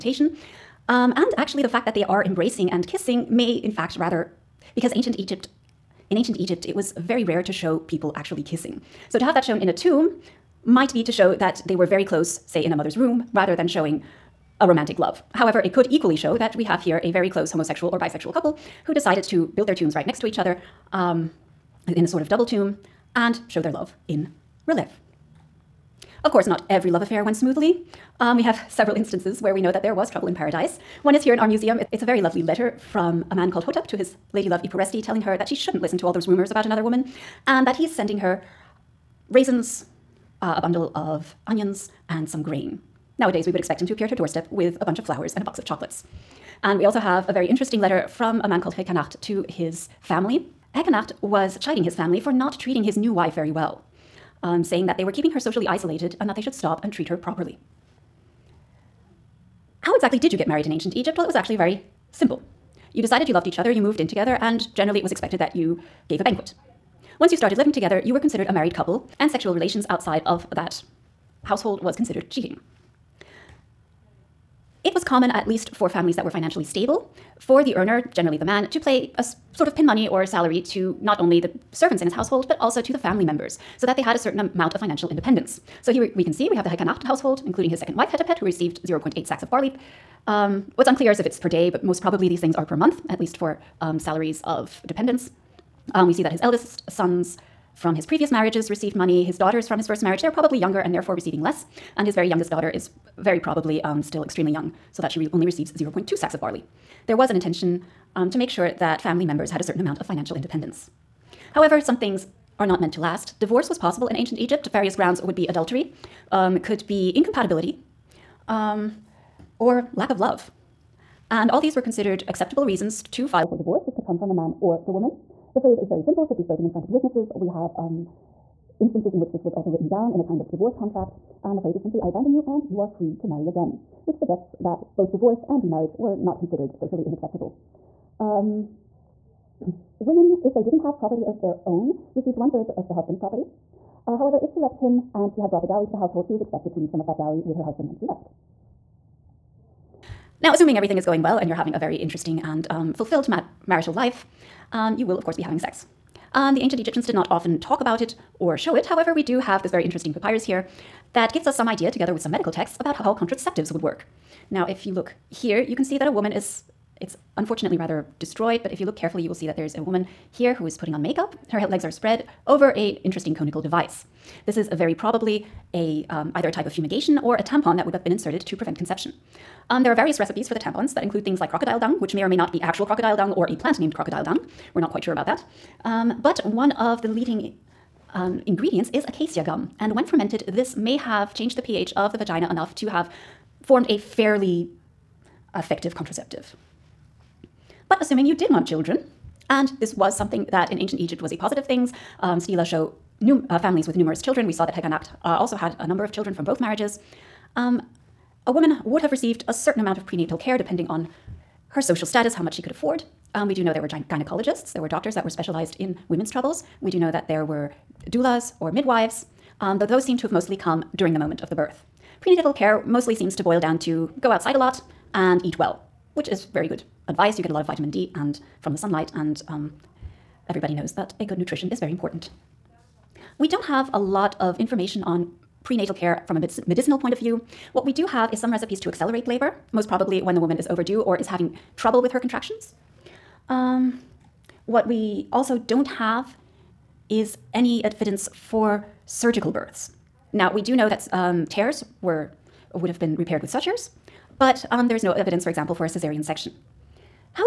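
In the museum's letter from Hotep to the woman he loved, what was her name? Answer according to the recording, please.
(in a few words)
Ipuresti.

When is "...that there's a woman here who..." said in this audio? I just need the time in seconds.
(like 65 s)
169 s.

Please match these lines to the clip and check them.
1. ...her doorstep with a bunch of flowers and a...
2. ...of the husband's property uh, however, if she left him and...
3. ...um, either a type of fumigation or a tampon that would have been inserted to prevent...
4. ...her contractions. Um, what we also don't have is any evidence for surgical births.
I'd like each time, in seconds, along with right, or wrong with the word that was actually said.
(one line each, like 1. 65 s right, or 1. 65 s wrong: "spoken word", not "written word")
1. 44 s right
2. 142 s right
3. 176 s right
4. 242 s right.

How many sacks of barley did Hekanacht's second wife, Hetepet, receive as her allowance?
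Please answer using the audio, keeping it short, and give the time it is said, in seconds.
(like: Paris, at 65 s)
0.8, at 88 s.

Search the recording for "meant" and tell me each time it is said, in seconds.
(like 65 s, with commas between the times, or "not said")
112 s.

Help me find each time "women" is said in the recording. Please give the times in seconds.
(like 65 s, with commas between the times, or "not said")
139 s, 216 s.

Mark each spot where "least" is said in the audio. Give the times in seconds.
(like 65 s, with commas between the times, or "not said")
75 s, 93 s.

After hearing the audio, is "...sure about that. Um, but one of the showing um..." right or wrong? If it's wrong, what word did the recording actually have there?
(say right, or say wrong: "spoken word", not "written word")
wrong: "leading", not "showing".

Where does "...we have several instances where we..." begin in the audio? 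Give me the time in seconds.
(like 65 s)
28 s.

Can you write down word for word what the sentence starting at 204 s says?
We saw that Hekanacht uh, also had a number of children from both marriages.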